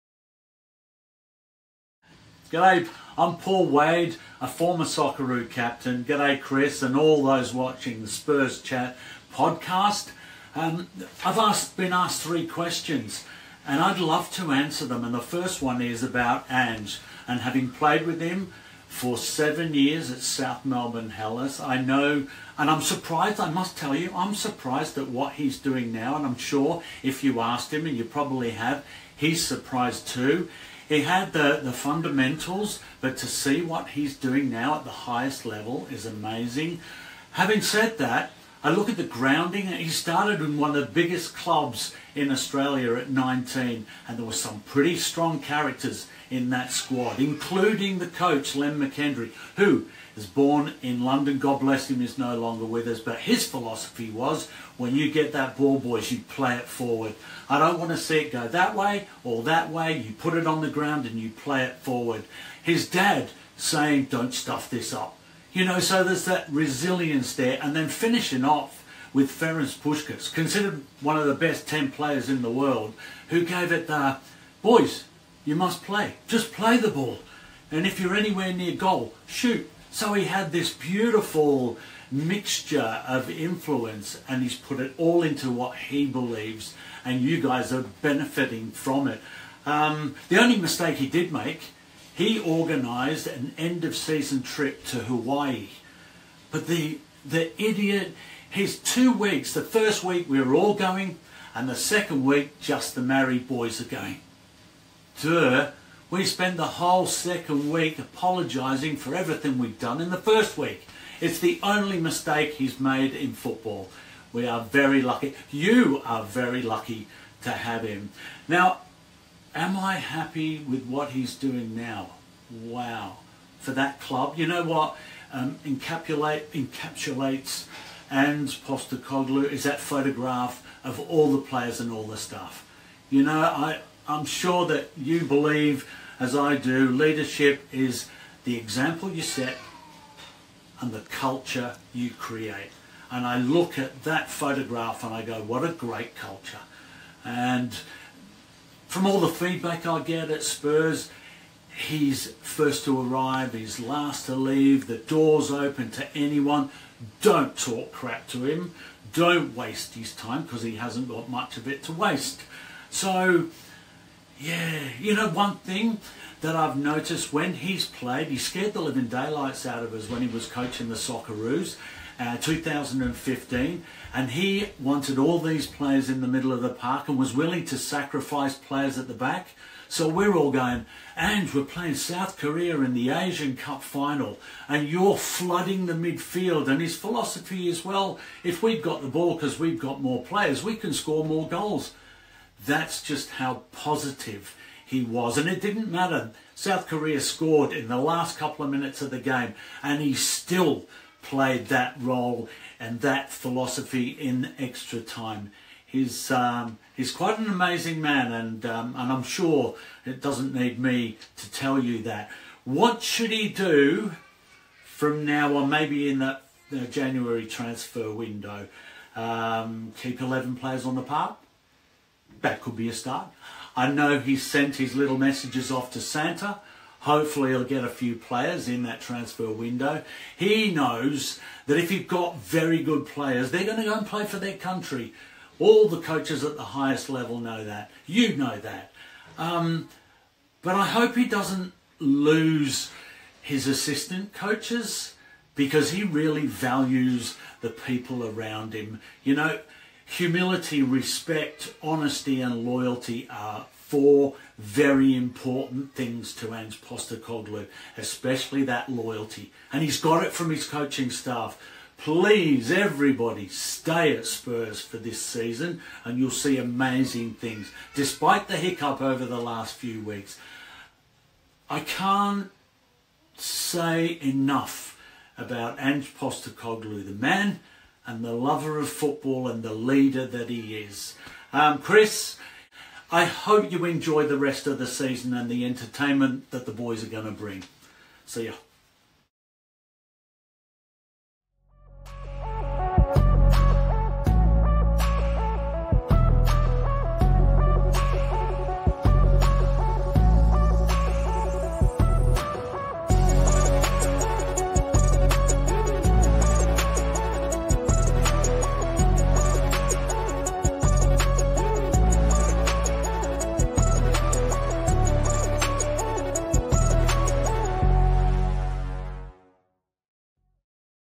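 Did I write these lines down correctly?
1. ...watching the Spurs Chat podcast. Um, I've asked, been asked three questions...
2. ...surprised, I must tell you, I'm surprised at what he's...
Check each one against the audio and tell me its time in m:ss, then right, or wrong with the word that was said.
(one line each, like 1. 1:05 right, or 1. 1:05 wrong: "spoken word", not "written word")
1. 0:07 right
2. 0:22 right.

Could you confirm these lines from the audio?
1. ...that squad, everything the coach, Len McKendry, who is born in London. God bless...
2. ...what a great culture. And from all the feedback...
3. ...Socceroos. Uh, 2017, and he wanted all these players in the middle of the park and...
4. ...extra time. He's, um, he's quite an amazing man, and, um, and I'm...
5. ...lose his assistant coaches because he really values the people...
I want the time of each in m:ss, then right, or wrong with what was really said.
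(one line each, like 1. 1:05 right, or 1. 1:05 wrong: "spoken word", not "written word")
1. 0:46 wrong: "including", not "everything"
2. 2:25 right
3. 2:50 wrong: "2015", not "2017"
4. 3:24 right
5. 4:01 right.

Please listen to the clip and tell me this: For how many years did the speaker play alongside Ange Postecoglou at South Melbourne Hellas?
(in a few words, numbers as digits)
7.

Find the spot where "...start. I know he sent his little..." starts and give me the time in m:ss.
3:42.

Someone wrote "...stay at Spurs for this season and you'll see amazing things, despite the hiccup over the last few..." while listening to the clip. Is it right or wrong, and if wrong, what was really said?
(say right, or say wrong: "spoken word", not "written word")
right.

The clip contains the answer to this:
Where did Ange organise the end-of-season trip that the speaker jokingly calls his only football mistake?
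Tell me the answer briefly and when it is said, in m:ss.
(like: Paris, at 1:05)
Hawaii, at 1:34.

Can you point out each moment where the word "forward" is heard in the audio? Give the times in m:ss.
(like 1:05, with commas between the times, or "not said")
0:56, 1:01.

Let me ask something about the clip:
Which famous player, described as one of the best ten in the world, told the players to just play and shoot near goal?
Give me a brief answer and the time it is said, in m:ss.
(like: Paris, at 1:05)
Ferenc Puskas, at 1:09.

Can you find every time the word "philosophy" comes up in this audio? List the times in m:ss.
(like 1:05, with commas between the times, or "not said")
0:53, 3:06, 3:23.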